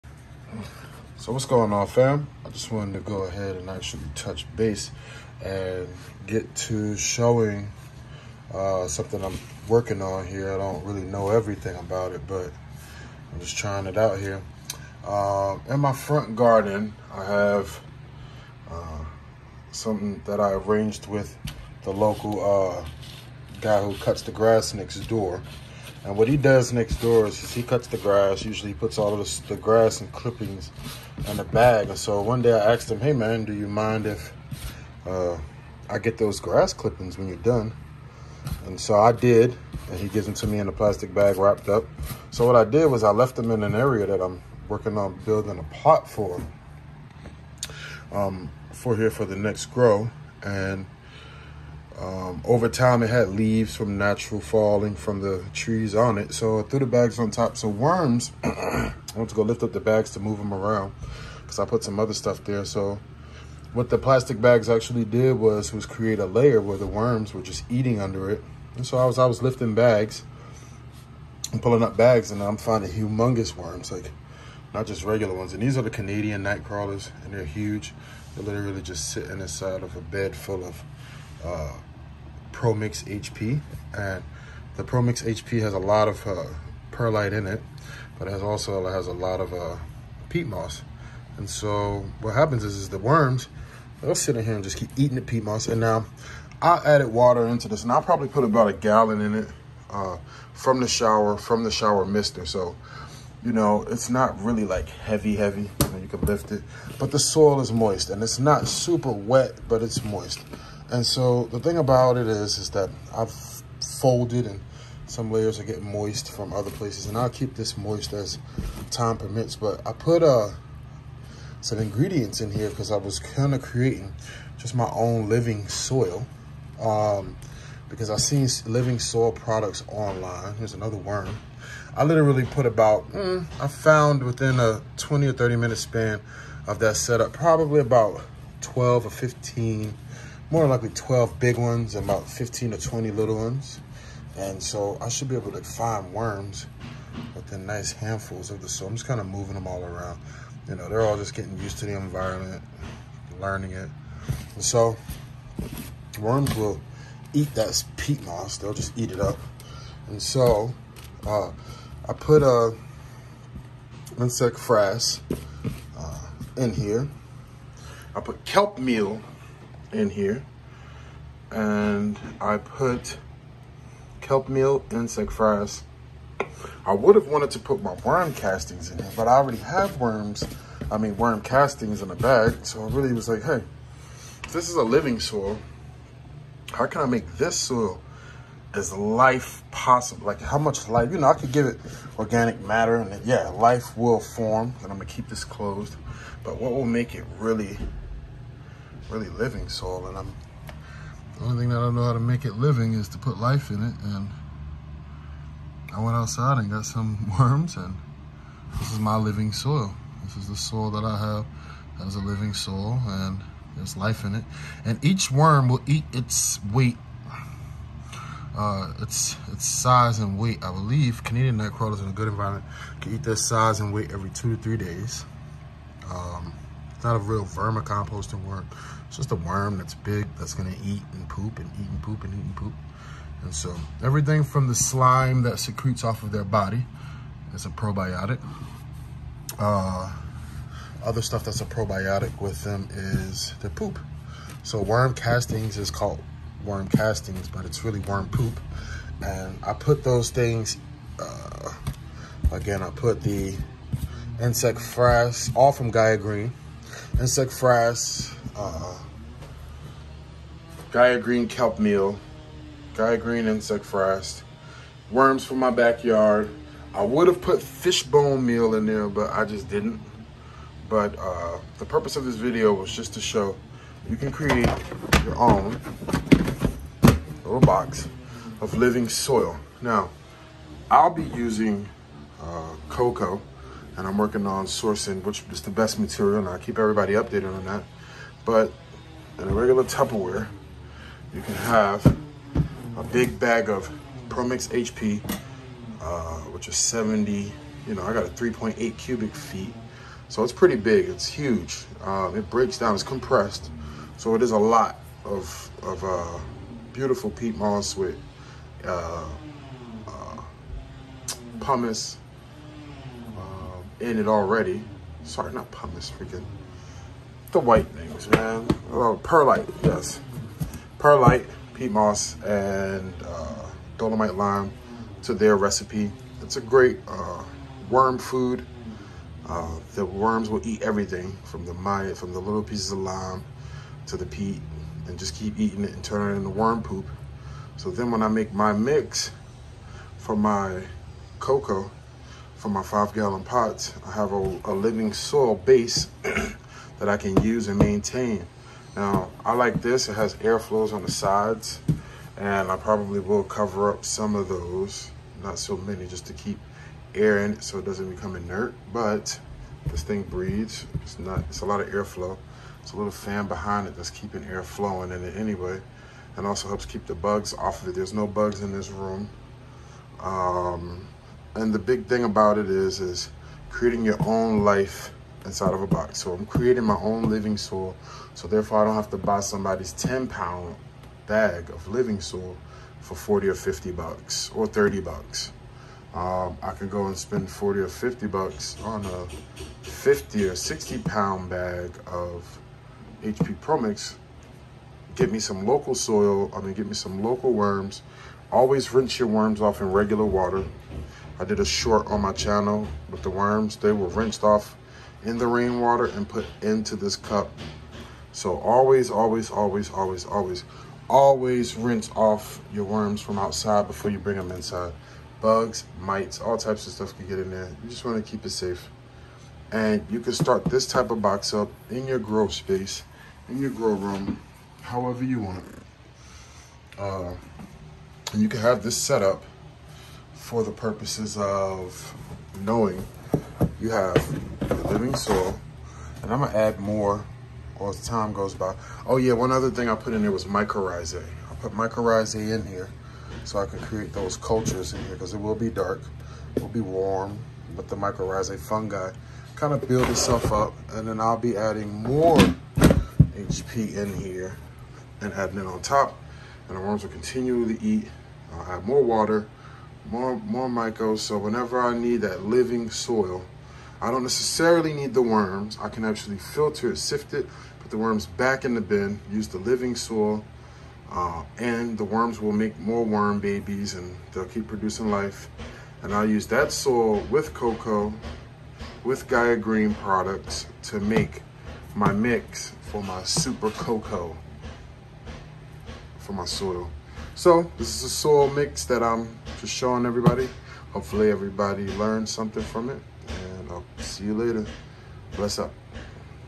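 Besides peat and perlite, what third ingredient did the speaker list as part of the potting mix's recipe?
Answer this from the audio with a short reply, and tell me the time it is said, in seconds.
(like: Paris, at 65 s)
dolomite lime, at 323 s.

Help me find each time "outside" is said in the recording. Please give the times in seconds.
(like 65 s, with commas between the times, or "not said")
206 s, 413 s.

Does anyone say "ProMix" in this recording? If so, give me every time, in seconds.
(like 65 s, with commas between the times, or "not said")
82 s, 294 s, 393 s.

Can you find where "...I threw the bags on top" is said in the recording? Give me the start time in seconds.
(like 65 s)
56 s.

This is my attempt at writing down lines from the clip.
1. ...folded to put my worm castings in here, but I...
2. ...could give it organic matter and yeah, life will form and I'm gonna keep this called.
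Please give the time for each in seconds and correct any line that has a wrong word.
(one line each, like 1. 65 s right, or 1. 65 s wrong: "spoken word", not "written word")
1. 177 s wrong: "wanted", not "folded"
2. 191 s wrong: "closed", not "called".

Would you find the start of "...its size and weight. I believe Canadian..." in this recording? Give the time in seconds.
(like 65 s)
219 s.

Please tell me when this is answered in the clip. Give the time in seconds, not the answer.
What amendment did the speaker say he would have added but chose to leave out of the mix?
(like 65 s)
267 s.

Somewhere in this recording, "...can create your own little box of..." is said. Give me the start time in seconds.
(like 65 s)
274 s.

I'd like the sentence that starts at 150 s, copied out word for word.
You know, they're all just getting used to the environment, learning it.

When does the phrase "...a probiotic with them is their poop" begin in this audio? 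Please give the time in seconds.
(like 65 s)
241 s.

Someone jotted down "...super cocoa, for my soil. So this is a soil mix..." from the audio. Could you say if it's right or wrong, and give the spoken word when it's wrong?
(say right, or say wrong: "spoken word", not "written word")
right.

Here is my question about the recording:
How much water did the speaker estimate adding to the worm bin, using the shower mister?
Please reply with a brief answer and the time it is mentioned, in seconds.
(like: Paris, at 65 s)
a gallon, at 98 s.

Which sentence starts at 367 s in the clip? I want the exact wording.
There's no bugs in this room.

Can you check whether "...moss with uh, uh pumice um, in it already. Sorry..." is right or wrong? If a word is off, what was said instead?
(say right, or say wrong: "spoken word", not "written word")
right.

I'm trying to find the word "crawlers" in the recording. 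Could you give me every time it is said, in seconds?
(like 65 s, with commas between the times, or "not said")
76 s, 221 s.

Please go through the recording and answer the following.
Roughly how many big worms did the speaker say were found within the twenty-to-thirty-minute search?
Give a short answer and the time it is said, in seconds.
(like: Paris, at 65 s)
12, at 140 s.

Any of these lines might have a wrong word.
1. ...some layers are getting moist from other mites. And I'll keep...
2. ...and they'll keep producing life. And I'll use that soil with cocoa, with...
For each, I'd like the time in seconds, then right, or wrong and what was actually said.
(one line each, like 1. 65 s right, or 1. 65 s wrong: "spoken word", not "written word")
1. 115 s wrong: "places", not "mites"
2. 473 s right.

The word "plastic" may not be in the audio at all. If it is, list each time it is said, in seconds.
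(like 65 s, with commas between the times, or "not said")
40 s, 63 s.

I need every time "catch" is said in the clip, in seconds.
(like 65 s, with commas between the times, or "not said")
not said.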